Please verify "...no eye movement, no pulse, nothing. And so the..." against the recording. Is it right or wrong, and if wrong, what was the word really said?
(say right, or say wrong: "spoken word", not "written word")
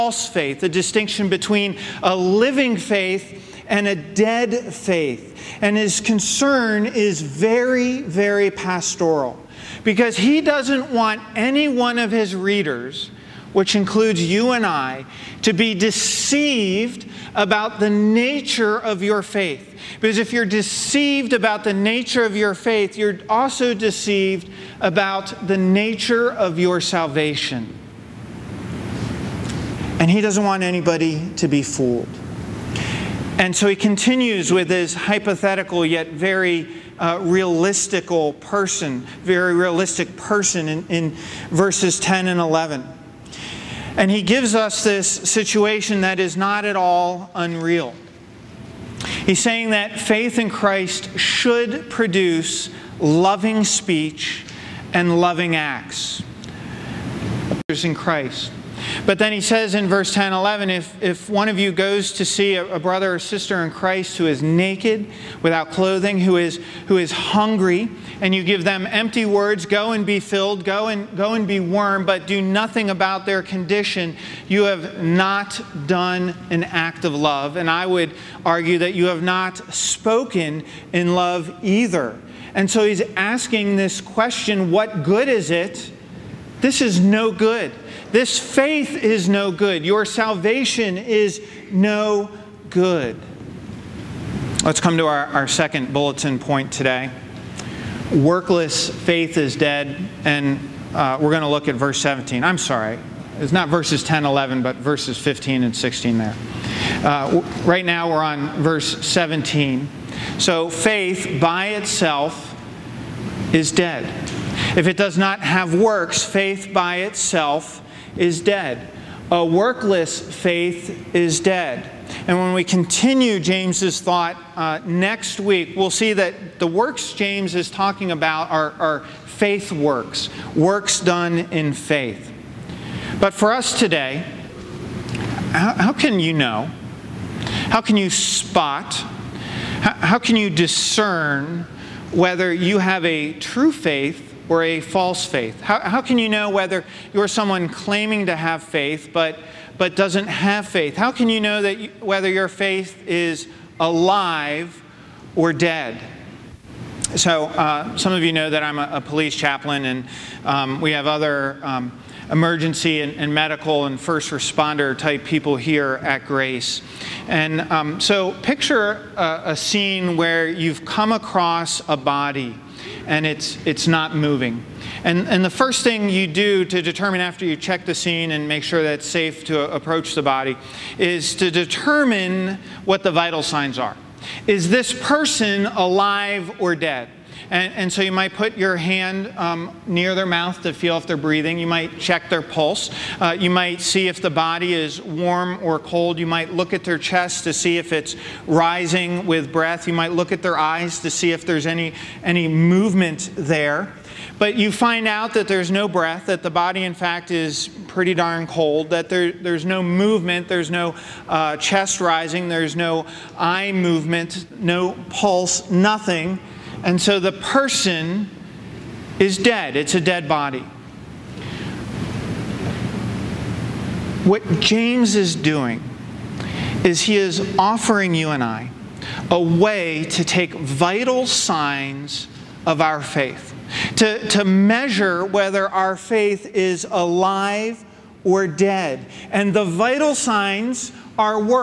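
right.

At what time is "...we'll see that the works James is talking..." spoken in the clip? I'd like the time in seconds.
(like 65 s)
125 s.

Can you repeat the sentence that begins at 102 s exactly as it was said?
I'm sorry, it's not verses 10, 11, but verses 15 and 16 there.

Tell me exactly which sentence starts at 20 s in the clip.
Because if you're deceived about the nature of your faith, you're also deceived about the nature of your salvation.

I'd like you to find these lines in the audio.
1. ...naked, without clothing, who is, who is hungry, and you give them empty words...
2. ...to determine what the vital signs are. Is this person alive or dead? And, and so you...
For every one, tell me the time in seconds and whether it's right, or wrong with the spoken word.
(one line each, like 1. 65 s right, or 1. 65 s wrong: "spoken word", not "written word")
1. 64 s right
2. 181 s right.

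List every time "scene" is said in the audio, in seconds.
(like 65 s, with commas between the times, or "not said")
169 s, 177 s.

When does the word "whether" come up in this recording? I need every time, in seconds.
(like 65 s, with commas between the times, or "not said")
142 s, 146 s, 152 s, 235 s.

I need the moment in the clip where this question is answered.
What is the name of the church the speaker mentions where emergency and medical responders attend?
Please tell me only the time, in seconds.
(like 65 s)
166 s.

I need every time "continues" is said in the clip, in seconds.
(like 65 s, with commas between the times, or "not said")
33 s, 122 s.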